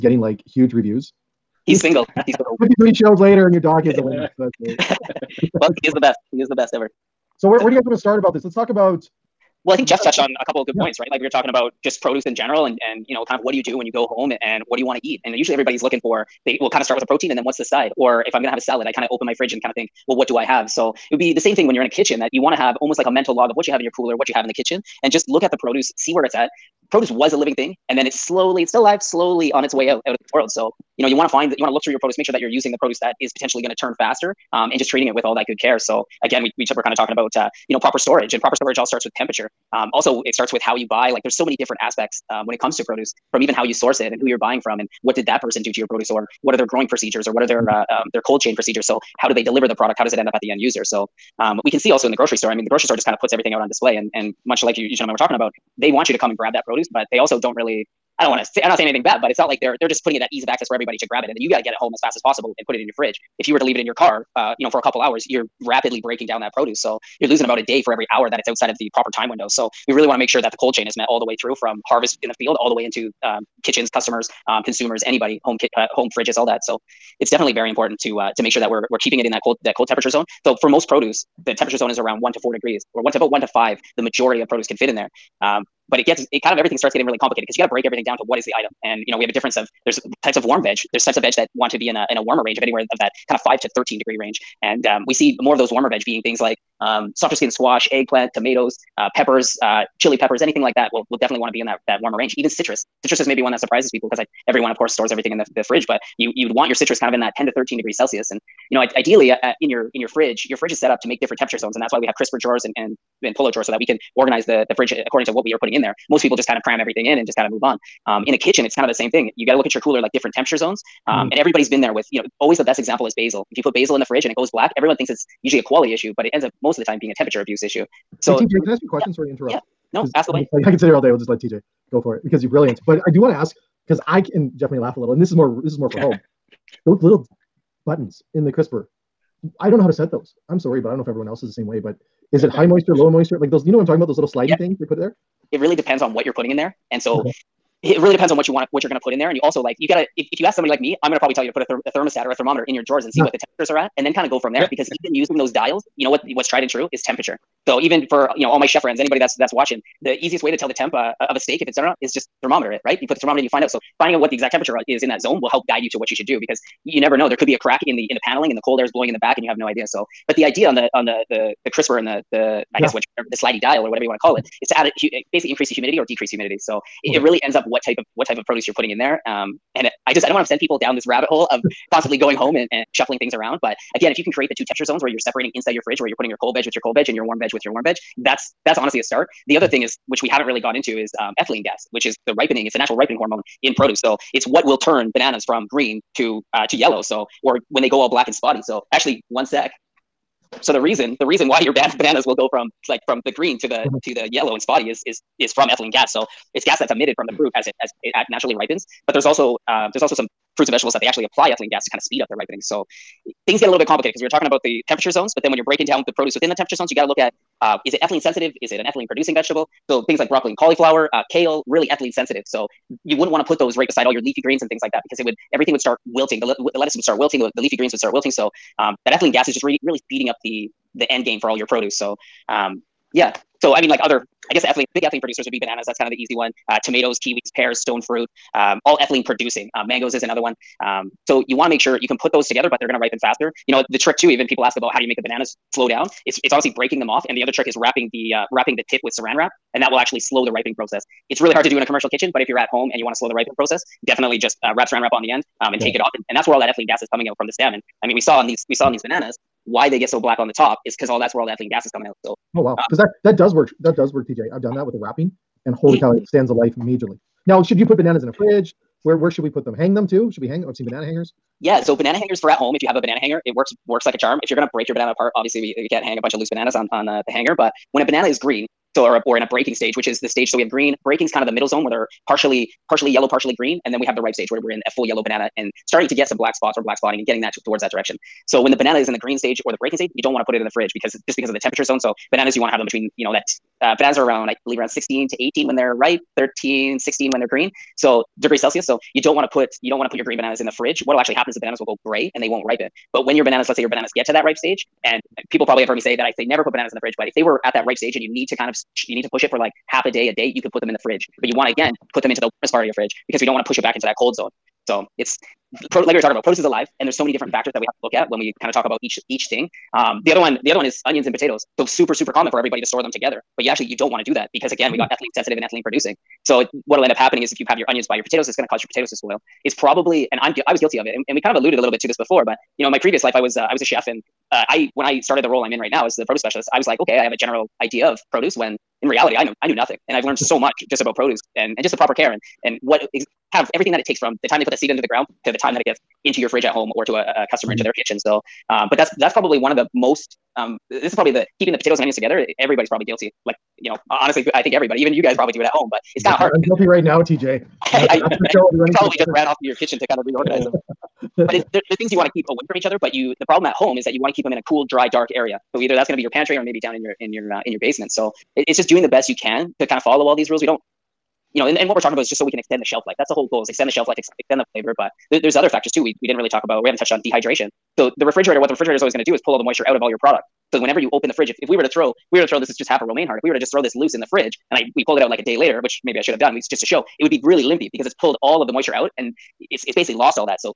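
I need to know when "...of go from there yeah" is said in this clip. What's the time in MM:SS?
02:34.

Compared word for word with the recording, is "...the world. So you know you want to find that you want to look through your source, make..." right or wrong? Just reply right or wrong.
wrong.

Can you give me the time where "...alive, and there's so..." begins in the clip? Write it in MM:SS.
05:16.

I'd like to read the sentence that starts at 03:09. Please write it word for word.
The other thing is, which we haven't really gone into, is um, ethylene gas, which is the ripening.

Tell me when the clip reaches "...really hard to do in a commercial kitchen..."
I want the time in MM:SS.
04:11.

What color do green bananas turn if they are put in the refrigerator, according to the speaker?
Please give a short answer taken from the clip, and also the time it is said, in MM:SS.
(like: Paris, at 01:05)
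gray, at 05:02.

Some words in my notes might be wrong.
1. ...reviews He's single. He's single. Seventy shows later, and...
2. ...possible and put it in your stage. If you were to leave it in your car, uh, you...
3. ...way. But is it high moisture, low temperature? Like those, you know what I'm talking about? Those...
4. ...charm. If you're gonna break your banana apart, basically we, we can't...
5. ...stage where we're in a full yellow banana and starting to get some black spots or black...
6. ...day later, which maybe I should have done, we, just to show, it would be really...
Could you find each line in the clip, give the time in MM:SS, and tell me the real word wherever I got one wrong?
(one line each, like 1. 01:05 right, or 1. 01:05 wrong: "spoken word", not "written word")
1. 00:00 wrong: "Fifty", not "Seventy"
2. 01:02 wrong: "fridge", not "stage"
3. 02:21 wrong: "moisture", not "temperature"
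4. 04:34 wrong: "obviously", not "basically"
5. 04:44 right
6. 06:25 right.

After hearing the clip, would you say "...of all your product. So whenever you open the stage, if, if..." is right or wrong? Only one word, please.
wrong.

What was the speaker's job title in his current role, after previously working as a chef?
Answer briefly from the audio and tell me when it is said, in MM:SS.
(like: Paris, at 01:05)
produce specialist, at 05:36.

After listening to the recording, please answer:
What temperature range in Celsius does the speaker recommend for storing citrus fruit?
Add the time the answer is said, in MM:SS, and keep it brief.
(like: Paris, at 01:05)
10 to 13 degrees, at 01:47.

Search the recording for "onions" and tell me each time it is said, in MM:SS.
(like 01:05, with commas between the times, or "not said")
05:21, 05:27, 05:52.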